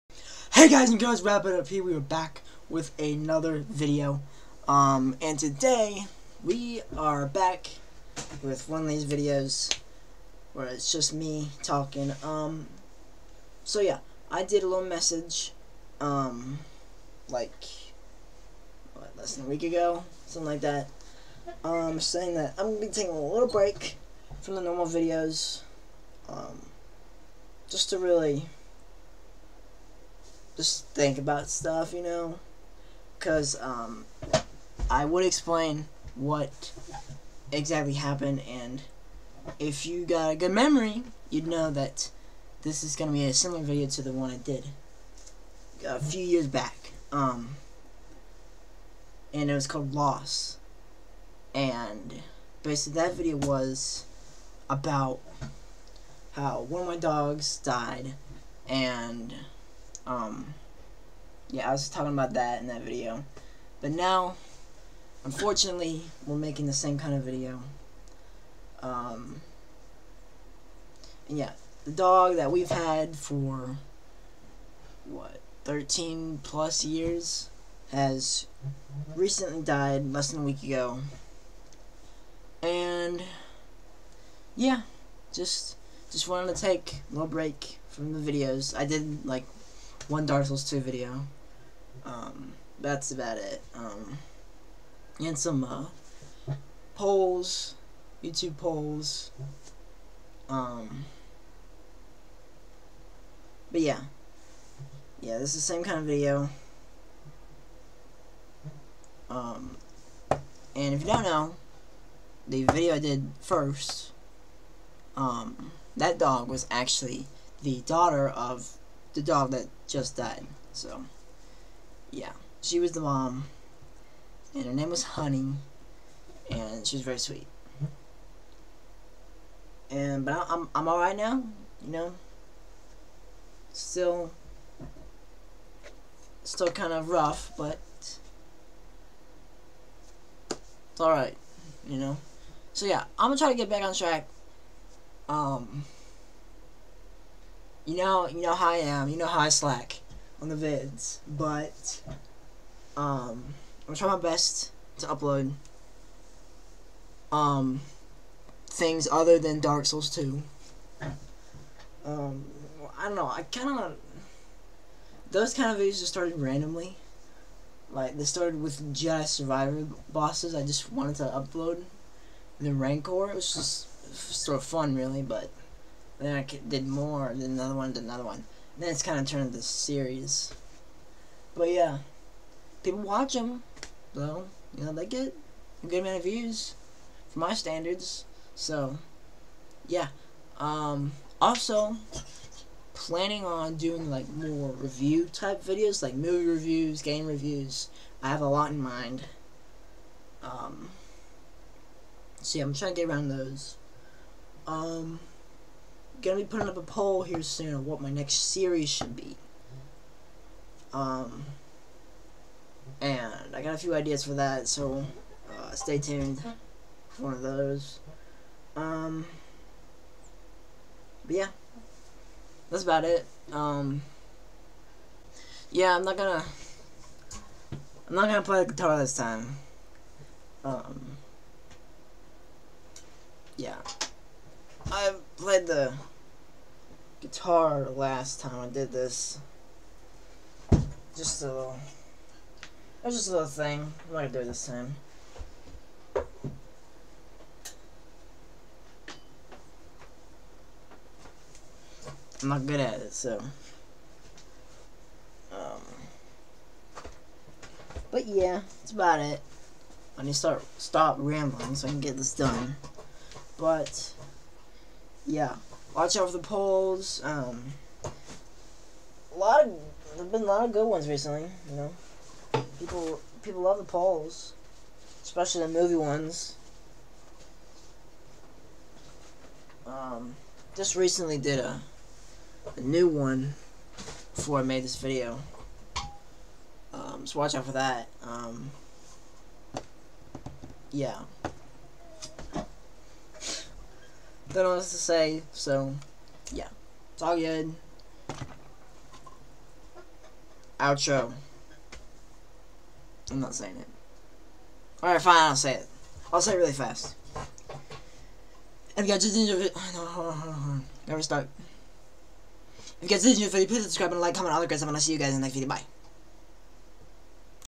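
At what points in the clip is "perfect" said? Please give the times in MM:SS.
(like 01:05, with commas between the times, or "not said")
not said.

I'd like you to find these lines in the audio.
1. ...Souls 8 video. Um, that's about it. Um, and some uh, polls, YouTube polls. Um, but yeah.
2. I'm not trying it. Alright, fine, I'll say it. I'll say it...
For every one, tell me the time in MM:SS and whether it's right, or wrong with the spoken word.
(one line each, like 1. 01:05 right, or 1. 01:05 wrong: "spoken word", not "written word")
1. 01:30 wrong: "2", not "8"
2. 05:03 wrong: "saying", not "trying".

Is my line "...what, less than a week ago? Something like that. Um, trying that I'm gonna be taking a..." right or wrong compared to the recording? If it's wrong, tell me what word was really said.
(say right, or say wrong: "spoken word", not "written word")
wrong: "saying", not "trying".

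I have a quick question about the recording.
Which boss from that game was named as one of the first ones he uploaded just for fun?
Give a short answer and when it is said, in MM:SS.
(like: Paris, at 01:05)
The Rancor, at 02:52.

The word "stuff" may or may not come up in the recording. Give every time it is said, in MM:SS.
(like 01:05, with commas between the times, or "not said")
00:31, 05:14.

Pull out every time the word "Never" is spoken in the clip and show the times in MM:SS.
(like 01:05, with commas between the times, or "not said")
05:11.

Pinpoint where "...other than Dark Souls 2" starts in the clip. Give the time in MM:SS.
02:39.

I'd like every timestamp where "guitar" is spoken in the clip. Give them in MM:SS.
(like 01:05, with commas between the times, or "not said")
03:48, 03:57.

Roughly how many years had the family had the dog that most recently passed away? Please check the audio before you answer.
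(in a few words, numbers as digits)
13.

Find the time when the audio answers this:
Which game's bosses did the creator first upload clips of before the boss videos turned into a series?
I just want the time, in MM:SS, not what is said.
02:48.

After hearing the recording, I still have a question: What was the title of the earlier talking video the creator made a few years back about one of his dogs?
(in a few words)
Loss.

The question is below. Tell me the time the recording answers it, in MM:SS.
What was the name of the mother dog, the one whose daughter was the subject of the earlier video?
02:05.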